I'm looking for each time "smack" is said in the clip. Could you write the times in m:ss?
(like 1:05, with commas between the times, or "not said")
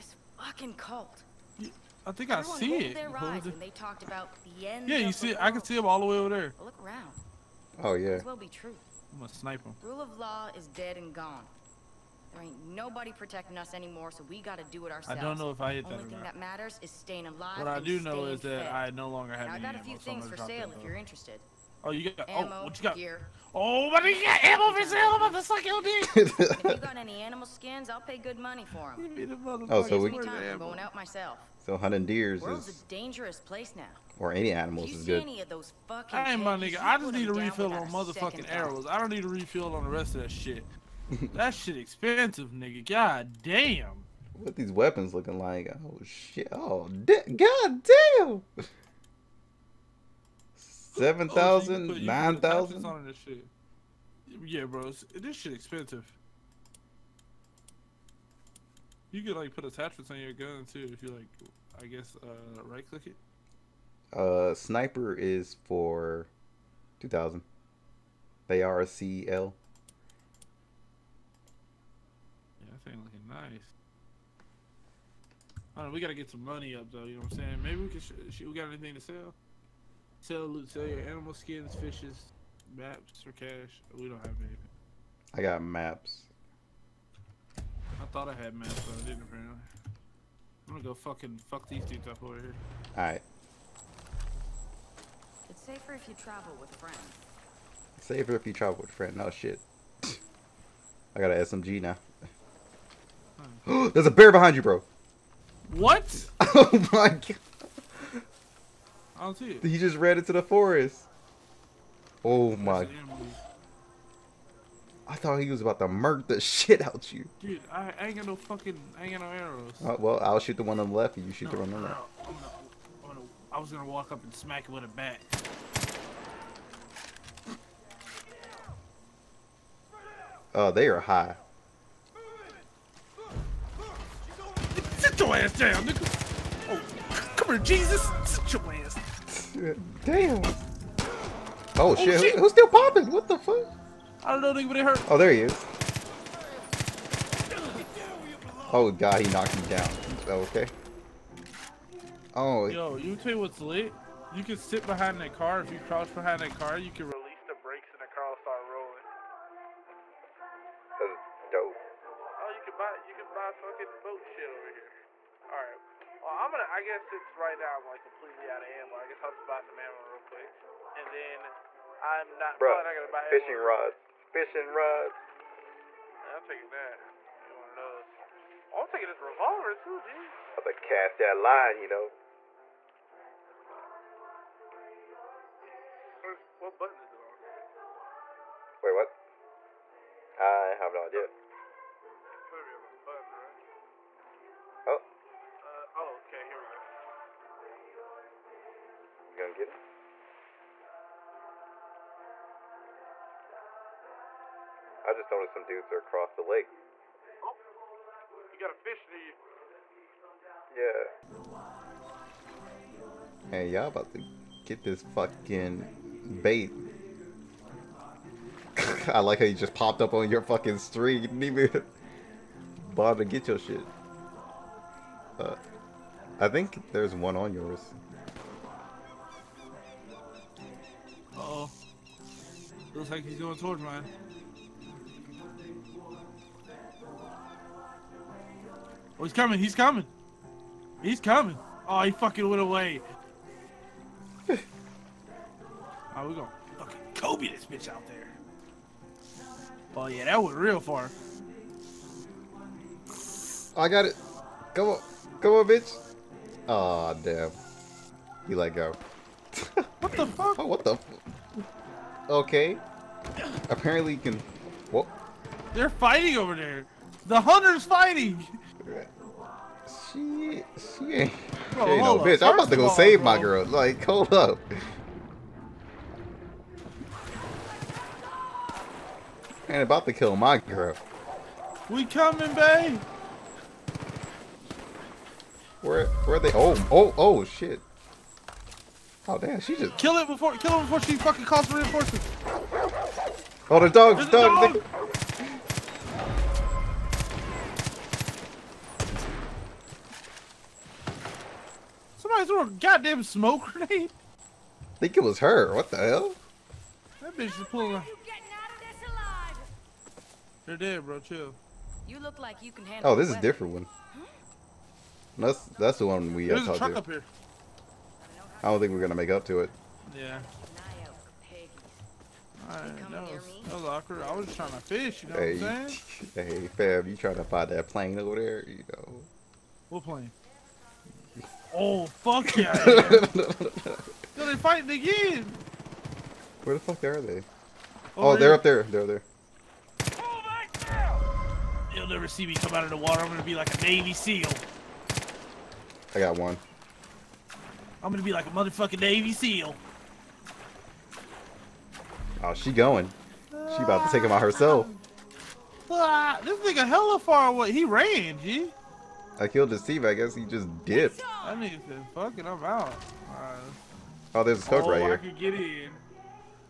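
2:04.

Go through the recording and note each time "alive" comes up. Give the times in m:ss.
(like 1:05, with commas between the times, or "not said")
0:17.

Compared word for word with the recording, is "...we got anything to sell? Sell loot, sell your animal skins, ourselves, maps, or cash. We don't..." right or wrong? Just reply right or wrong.
wrong.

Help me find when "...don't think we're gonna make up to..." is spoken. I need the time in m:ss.
5:18.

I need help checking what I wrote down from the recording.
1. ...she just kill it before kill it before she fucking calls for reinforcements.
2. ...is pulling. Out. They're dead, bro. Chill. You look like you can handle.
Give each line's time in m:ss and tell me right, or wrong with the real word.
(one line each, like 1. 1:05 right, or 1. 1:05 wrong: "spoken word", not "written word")
1. 4:49 right
2. 5:07 right.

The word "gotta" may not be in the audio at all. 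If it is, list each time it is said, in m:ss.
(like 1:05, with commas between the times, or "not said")
0:14, 1:15.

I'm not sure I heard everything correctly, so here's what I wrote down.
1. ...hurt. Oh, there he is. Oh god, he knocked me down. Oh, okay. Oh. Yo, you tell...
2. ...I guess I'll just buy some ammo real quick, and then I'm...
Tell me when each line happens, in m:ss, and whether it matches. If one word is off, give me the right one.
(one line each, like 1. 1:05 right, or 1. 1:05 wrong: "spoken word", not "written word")
1. 2:24 right
2. 2:48 right.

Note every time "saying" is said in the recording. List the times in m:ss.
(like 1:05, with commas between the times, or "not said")
1:17, 5:25.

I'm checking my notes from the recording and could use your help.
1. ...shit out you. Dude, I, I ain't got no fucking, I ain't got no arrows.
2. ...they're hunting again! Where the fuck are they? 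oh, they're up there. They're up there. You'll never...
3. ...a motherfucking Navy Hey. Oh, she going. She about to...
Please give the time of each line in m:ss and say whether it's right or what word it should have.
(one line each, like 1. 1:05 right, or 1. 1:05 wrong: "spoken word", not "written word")
1. 1:56 right
2. 5:34 wrong: "fighting", not "hunting"
3. 5:48 wrong: "SEAL", not "Hey".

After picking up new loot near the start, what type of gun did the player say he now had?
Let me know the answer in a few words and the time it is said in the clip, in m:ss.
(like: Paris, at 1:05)
SMG, at 1:41.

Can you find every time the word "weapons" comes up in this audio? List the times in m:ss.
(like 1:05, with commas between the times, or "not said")
0:44.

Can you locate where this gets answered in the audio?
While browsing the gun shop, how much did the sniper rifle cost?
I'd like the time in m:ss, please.
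1:06.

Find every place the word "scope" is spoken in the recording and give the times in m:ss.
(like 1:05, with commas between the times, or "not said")
6:04.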